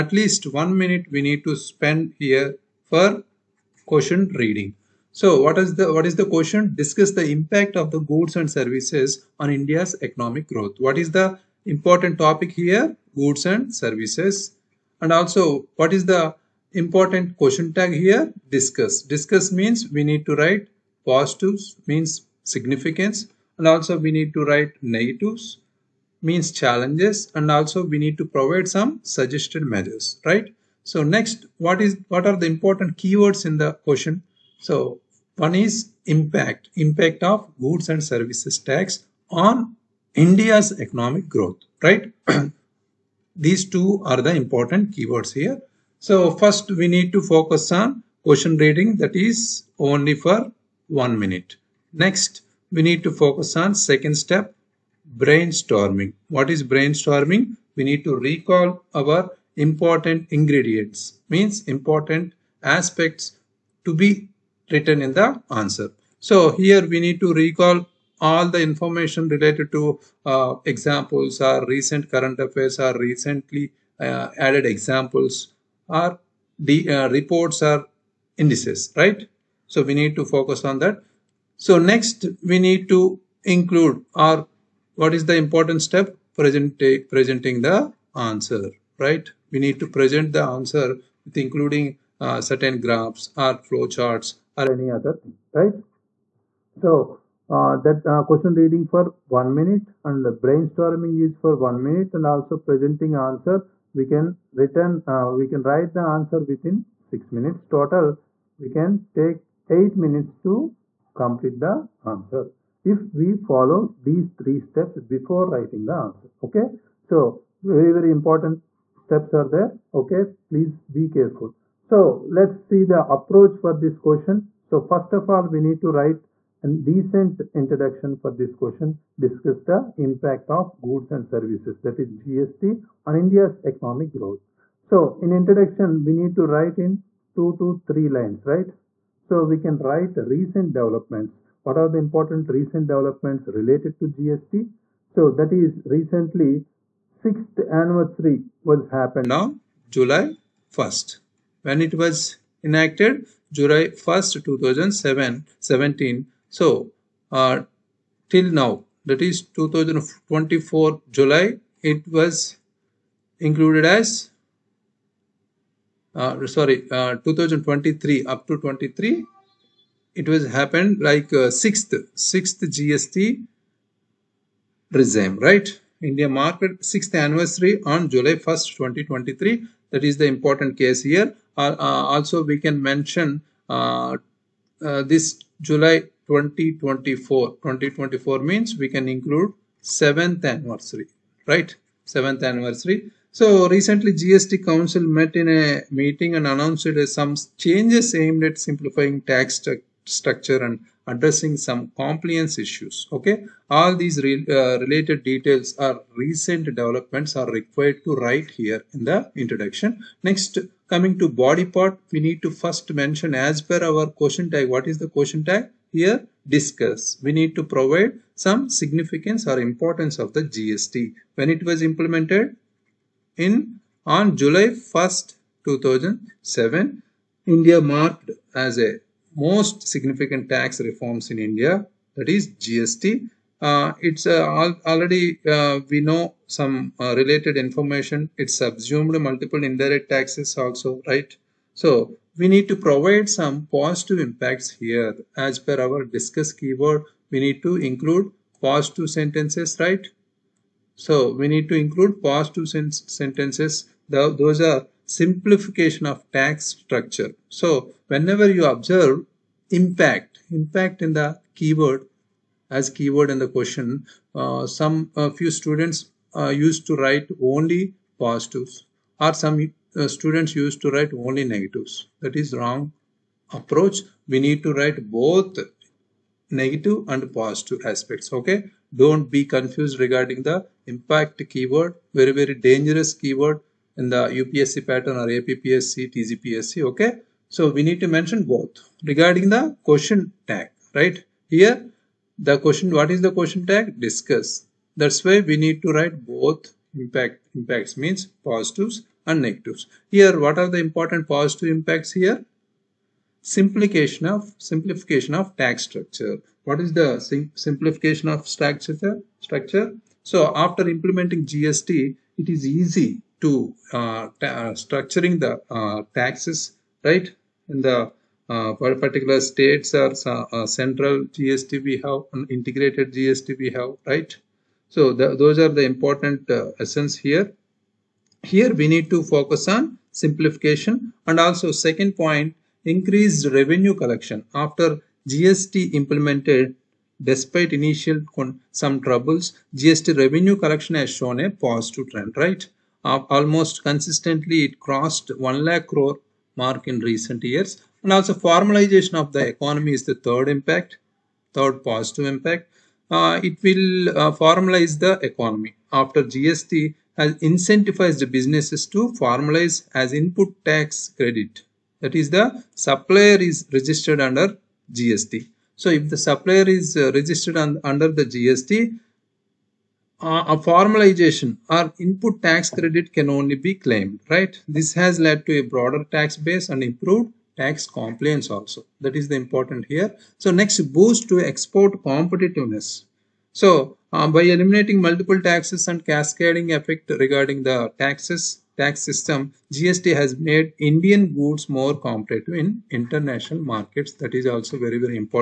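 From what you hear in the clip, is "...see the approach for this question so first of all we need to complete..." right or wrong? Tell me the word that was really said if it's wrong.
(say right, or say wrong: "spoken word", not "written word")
wrong: "write", not "complete".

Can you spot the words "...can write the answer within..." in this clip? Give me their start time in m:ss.
1:45.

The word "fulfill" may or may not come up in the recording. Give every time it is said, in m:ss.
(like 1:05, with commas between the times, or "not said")
not said.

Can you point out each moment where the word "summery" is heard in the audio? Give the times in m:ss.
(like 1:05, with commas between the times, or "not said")
not said.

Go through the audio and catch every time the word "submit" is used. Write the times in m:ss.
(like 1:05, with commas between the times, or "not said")
not said.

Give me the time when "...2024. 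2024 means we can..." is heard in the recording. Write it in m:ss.
3:06.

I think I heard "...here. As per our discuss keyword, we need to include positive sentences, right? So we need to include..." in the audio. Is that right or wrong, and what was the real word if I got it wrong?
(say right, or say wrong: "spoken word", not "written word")
right.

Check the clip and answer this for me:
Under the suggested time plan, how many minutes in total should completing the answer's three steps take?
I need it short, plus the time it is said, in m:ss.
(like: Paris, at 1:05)
8 minutes, at 1:49.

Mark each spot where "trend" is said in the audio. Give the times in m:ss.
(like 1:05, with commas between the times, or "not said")
5:42.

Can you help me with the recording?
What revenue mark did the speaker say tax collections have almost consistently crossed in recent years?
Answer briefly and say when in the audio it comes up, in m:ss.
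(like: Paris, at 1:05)
1 lakh crore, at 5:45.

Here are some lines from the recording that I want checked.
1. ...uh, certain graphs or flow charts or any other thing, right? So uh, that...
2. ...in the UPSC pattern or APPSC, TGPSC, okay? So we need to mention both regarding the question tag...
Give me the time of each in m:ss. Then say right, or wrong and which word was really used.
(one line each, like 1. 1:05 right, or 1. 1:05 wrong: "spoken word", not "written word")
1. 1:32 right
2. 4:43 right.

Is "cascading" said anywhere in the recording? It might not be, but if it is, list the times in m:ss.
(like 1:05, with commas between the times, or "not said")
6:26.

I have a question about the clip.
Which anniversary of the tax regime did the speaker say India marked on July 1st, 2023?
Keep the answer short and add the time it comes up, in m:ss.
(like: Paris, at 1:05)
sixth anniversary, at 2:56.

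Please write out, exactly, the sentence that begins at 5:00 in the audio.
Here, what are the important positive impacts here?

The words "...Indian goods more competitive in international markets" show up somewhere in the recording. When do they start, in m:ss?
6:30.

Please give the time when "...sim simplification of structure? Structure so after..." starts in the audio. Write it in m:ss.
5:07.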